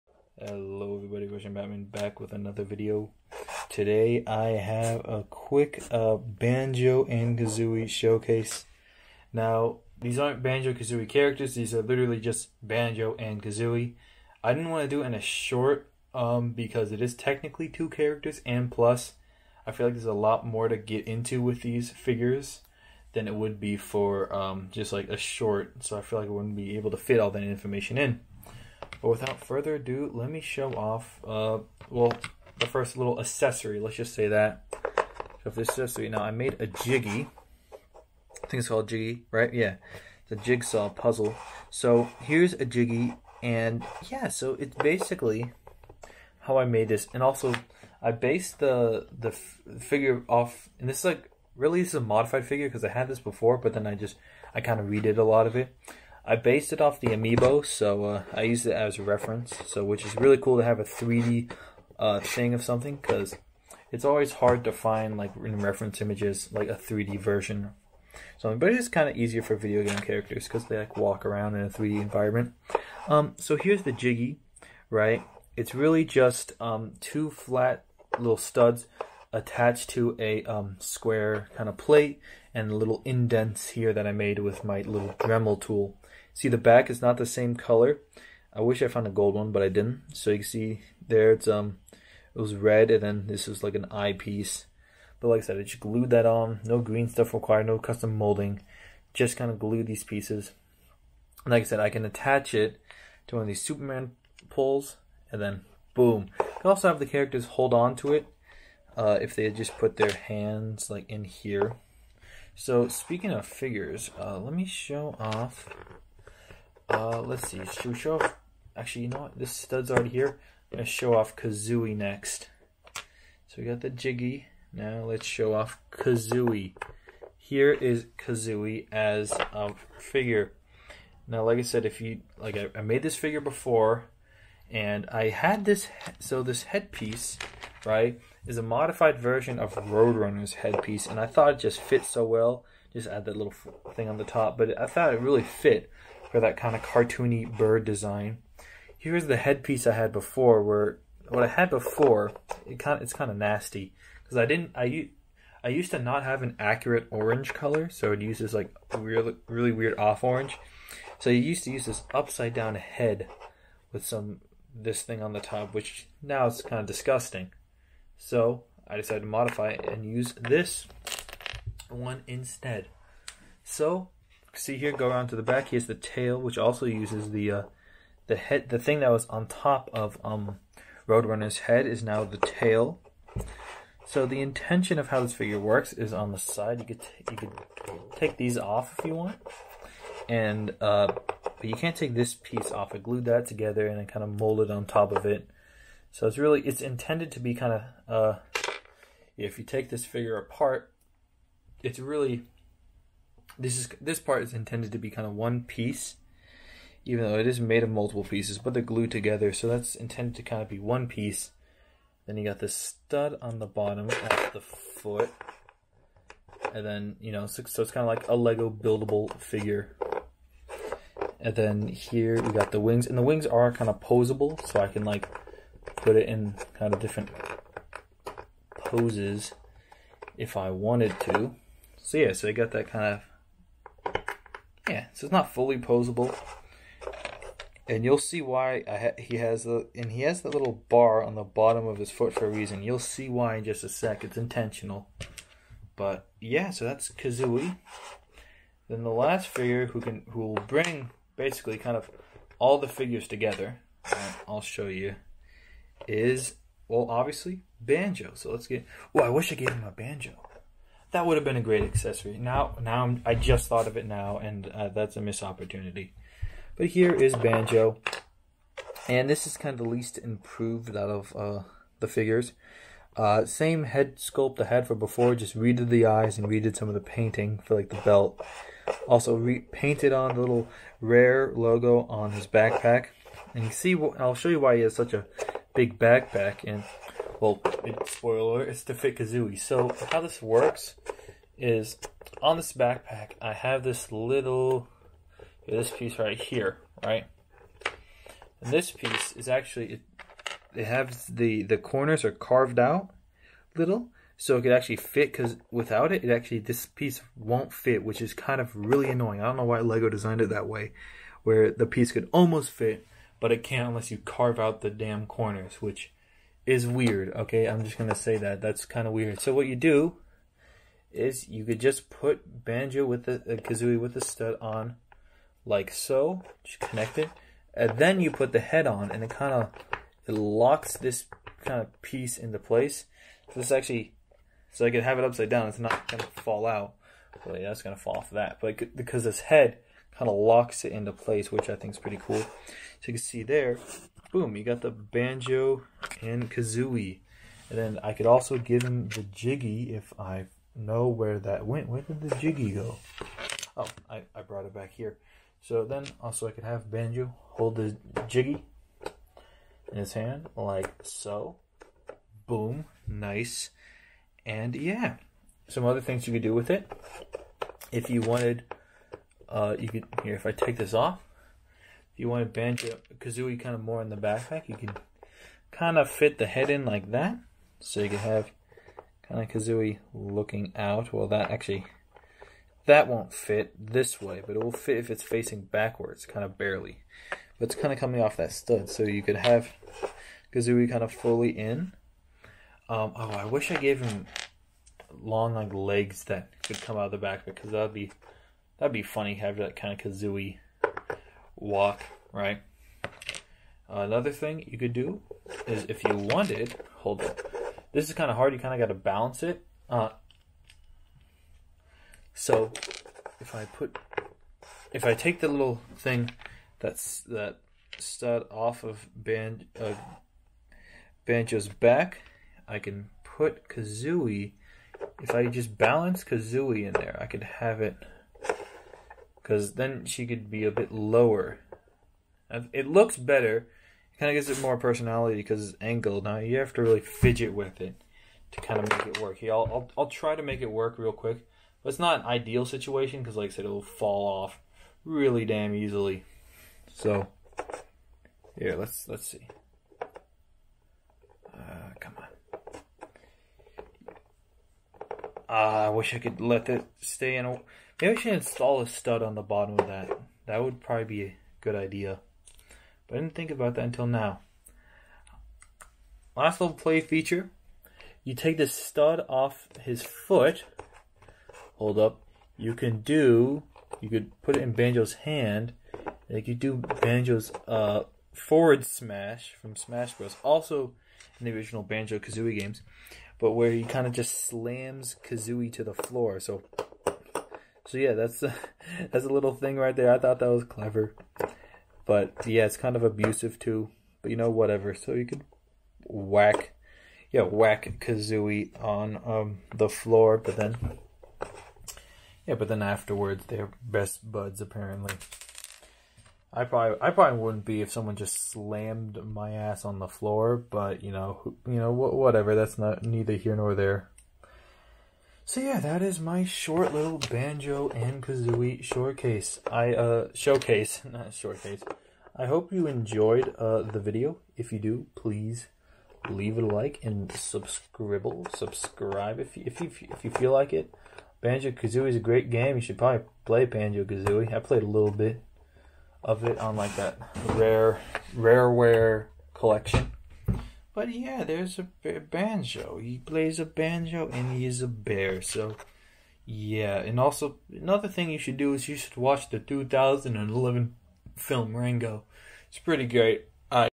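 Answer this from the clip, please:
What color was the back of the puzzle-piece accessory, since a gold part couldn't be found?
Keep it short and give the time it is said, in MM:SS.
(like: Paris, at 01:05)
red, at 01:32.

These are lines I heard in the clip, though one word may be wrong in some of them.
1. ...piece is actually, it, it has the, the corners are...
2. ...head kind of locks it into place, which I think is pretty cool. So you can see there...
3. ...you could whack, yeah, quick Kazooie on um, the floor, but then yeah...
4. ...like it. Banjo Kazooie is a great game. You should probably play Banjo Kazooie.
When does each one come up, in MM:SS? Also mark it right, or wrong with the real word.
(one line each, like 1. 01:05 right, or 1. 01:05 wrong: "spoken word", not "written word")
1. 04:58 right
2. 05:39 right
3. 08:15 wrong: "whack", not "quick"
4. 08:50 right.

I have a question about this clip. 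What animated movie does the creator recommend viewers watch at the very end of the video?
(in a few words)
Rango.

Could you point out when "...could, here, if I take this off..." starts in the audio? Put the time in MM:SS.
06:09.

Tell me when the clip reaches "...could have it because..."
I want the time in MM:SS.
07:07.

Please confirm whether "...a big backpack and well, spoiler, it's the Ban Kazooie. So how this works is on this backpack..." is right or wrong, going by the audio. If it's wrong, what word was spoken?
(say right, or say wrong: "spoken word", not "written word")
wrong: "Fit", not "Ban".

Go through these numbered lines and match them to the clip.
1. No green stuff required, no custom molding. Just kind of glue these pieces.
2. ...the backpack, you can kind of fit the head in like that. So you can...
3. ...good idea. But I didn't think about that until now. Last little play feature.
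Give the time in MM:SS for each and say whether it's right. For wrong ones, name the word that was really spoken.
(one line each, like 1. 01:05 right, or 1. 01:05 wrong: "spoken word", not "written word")
1. 01:36 right
2. 06:14 right
3. 07:41 right.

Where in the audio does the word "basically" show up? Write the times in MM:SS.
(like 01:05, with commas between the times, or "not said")
00:44, 04:11.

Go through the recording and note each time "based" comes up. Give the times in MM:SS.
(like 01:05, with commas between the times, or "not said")
00:48, 00:56.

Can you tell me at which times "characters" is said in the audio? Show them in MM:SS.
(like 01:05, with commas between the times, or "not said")
00:11, 00:17, 01:09, 01:47.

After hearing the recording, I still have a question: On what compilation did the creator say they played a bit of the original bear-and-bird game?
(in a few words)
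Rareware collection.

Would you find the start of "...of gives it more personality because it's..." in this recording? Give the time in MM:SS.
07:14.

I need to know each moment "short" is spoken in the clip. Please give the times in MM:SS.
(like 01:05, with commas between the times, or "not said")
00:15, 00:25, 08:36.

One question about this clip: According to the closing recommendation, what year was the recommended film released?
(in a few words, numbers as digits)
2011.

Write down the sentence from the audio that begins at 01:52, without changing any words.
So speaking of figures, uh, let me show off uh, let's see.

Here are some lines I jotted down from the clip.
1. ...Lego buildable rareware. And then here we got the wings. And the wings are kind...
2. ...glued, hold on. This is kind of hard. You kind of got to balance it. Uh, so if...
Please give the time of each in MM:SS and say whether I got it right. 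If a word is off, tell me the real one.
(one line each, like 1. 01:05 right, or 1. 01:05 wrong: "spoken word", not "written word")
1. 03:38 wrong: "figure", not "rareware"
2. 06:46 wrong: "wanted", not "glued".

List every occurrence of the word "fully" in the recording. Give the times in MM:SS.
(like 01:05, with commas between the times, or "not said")
03:55, 06:31.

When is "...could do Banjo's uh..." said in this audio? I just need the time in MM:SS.
07:56.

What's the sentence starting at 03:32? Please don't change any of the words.
Then you got this stud on the bottom at the foot.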